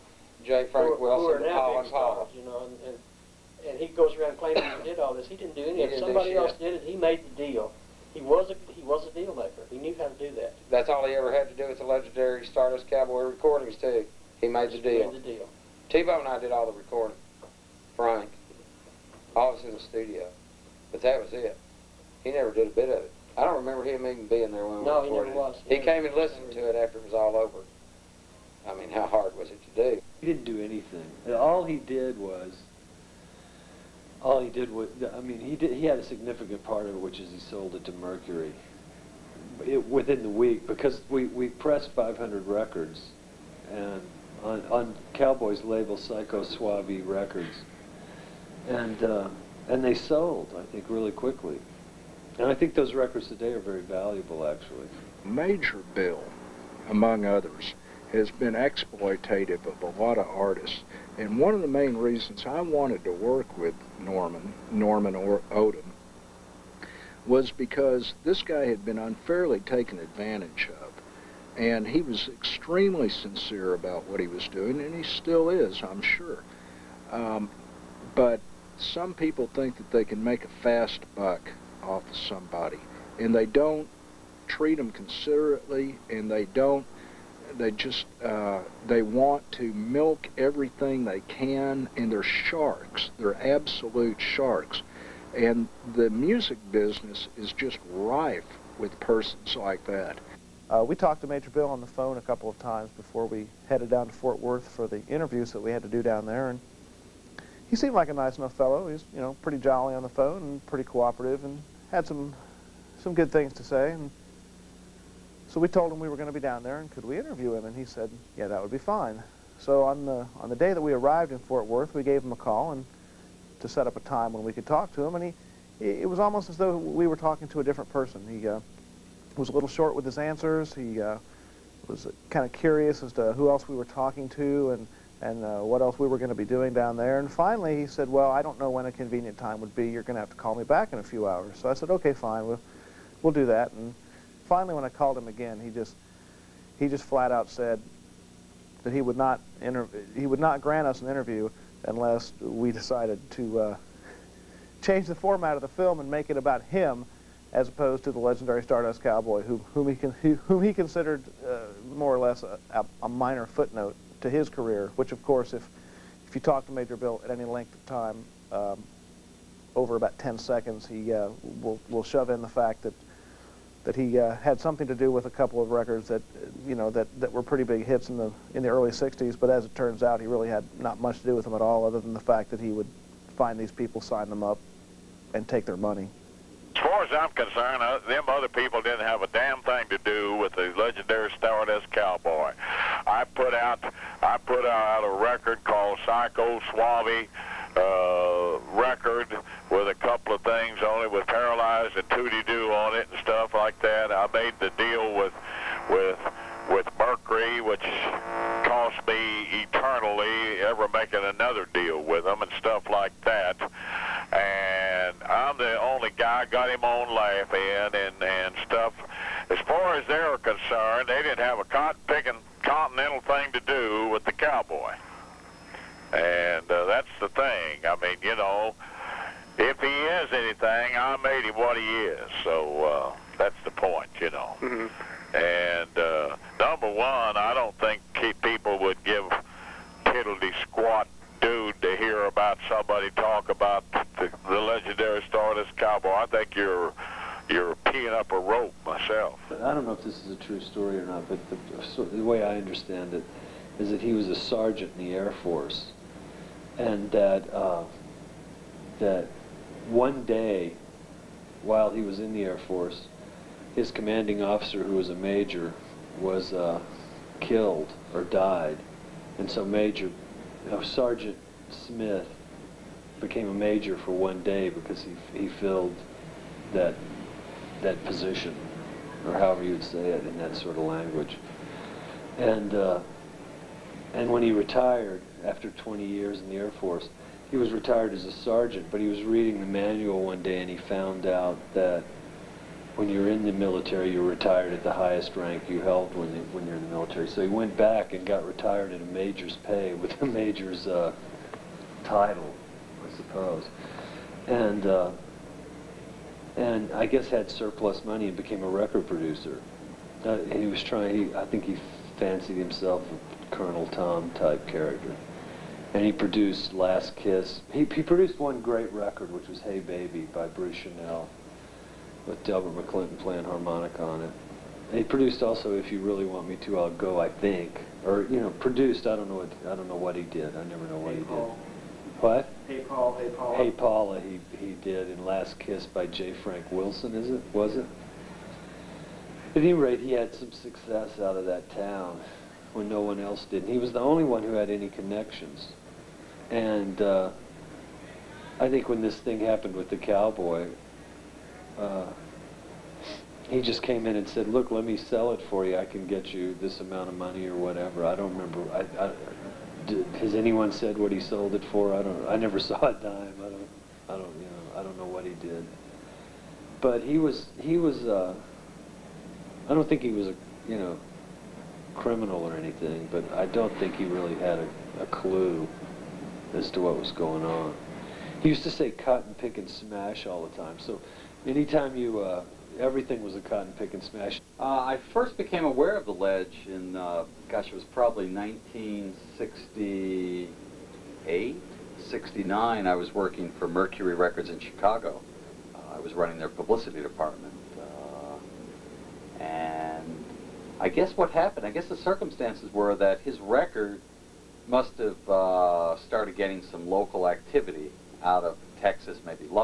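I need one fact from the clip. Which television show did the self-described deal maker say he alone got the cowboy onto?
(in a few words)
Laugh-In.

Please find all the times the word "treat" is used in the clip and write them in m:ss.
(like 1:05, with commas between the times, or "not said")
1:24.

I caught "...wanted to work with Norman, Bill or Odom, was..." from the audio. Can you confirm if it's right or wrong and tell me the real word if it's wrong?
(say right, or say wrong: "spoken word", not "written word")
wrong: "Norman", not "Bill".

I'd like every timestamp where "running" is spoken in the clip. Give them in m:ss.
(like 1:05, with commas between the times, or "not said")
6:36.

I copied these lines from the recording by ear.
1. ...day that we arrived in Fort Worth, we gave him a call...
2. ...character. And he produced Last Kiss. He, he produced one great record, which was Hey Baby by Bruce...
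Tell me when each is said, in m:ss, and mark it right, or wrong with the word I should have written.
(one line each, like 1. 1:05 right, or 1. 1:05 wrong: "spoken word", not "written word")
1. 2:00 right
2. 5:14 right.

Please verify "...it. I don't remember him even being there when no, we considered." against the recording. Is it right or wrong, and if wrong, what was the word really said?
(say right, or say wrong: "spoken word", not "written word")
wrong: "recorded", not "considered".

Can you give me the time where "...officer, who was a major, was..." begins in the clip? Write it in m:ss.
4:24.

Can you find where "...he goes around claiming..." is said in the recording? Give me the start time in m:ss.
0:03.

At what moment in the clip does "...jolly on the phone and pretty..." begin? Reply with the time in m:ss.
1:49.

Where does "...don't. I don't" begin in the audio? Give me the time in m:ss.
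6:03.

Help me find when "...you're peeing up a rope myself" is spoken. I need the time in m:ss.
4:07.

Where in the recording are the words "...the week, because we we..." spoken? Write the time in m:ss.
0:40.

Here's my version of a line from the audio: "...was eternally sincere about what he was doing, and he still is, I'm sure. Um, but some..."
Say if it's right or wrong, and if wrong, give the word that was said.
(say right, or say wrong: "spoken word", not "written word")
wrong: "extremely", not "eternally".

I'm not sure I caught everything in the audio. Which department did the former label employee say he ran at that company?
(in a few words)
Publicity.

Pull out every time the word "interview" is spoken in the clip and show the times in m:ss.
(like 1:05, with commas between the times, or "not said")
1:45, 1:57, 2:31.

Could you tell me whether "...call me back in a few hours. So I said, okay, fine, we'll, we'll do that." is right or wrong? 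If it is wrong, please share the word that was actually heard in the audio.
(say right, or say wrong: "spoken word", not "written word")
right.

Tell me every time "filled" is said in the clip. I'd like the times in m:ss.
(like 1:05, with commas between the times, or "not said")
4:35.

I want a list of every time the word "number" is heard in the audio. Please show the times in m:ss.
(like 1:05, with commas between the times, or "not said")
3:56.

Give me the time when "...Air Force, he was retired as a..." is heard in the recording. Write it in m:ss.
4:46.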